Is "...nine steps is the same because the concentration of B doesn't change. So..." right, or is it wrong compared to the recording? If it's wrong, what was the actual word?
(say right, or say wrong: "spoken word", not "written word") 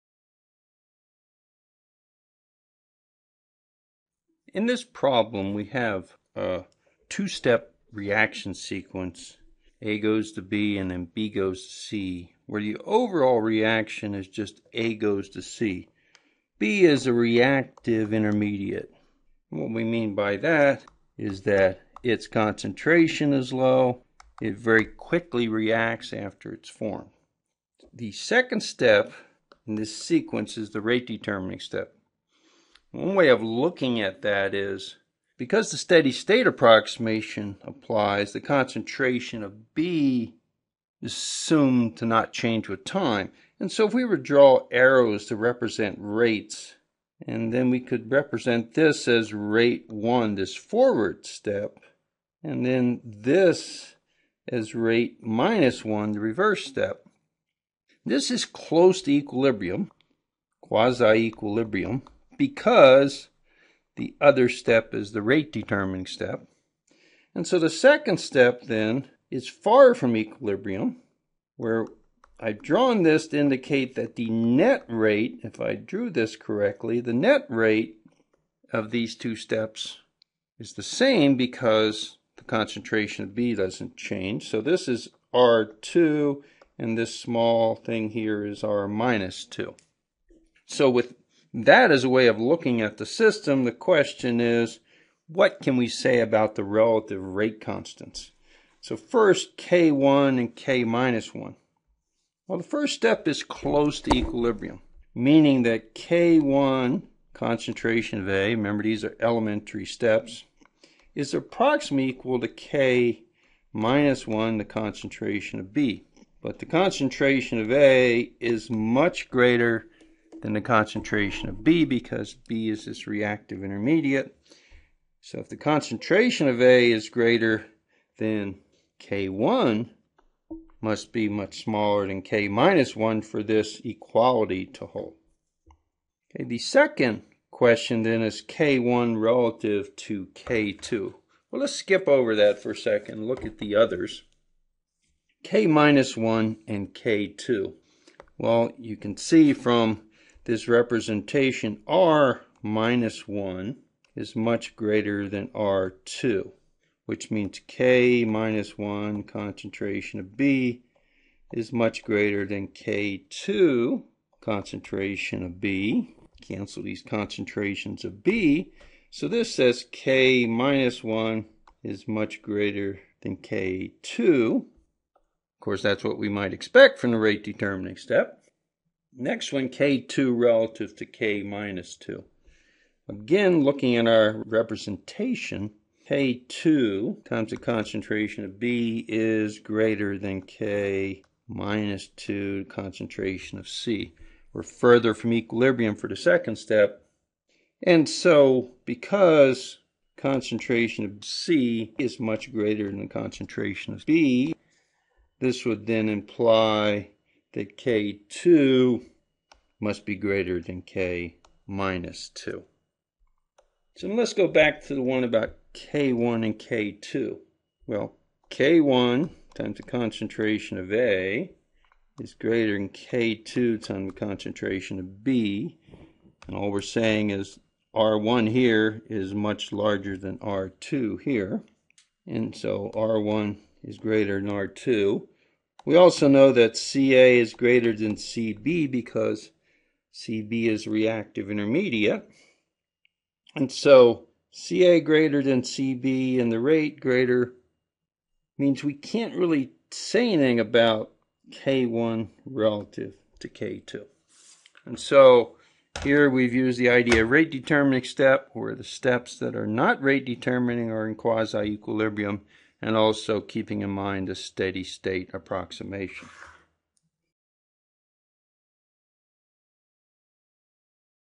wrong: "two", not "nine".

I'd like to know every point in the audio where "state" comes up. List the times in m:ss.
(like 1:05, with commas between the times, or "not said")
0:36, 4:24.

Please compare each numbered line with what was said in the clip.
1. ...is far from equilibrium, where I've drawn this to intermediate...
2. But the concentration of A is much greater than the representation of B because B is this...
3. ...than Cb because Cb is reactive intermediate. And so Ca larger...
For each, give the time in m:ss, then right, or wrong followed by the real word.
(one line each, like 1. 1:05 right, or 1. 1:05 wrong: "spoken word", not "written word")
1. 1:09 wrong: "indicate", not "intermediate"
2. 1:56 wrong: "concentration", not "representation"
3. 3:57 wrong: "greater", not "larger".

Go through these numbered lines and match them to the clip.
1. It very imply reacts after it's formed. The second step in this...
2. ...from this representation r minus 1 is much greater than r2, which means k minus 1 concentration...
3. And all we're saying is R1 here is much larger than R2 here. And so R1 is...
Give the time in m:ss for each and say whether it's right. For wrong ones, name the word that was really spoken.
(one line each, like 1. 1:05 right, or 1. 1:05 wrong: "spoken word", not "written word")
1. 0:24 wrong: "quickly", not "imply"
2. 2:29 right
3. 3:46 right.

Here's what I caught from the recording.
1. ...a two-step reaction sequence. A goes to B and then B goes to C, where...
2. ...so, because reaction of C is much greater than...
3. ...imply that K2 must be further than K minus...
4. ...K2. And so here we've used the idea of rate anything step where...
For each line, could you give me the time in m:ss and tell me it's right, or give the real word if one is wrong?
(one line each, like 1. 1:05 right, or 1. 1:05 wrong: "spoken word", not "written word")
1. 0:06 right
2. 3:18 wrong: "concentration", not "reaction"
3. 3:26 wrong: "greater", not "further"
4. 4:13 wrong: "determining", not "anything".